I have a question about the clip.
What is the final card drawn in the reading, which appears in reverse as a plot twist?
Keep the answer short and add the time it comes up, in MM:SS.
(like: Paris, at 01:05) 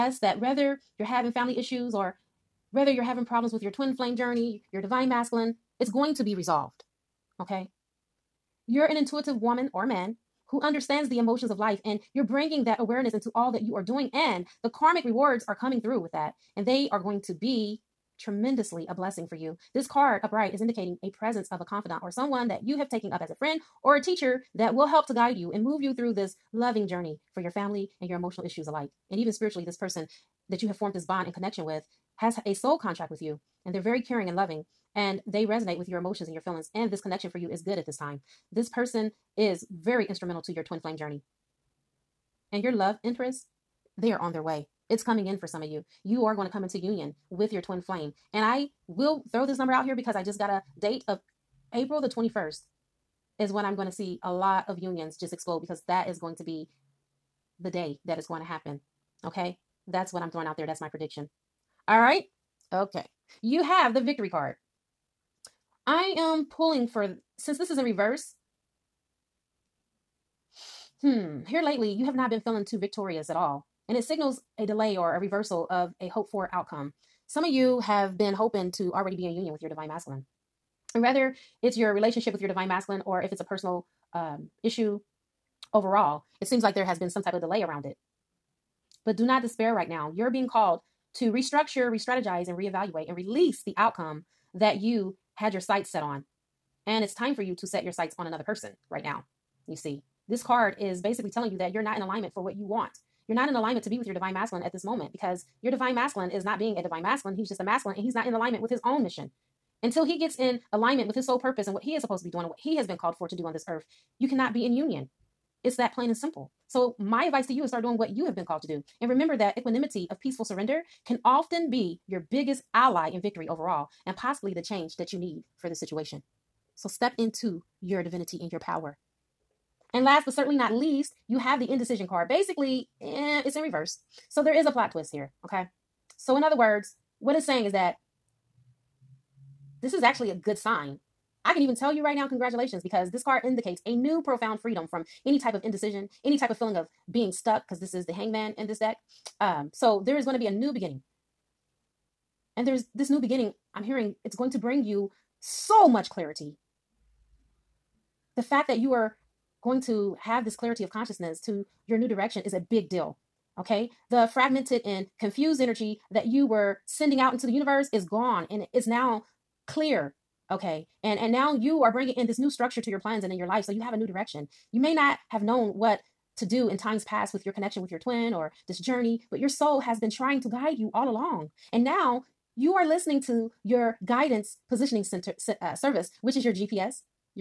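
Indecision card, at 02:11.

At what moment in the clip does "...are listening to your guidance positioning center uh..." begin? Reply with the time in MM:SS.
03:02.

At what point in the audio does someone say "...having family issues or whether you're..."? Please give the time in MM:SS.
00:01.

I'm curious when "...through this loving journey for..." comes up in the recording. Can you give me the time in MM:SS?
00:25.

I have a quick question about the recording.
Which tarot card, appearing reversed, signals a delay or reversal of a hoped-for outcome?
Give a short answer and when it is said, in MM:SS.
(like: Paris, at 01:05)
Victory card, at 01:03.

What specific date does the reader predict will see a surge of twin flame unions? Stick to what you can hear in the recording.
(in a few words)
April 21.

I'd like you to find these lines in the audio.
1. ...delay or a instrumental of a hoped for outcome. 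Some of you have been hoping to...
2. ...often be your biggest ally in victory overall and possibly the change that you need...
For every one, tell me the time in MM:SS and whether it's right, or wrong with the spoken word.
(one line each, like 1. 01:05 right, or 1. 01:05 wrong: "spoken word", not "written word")
1. 01:14 wrong: "reversal", not "instrumental"
2. 02:01 right.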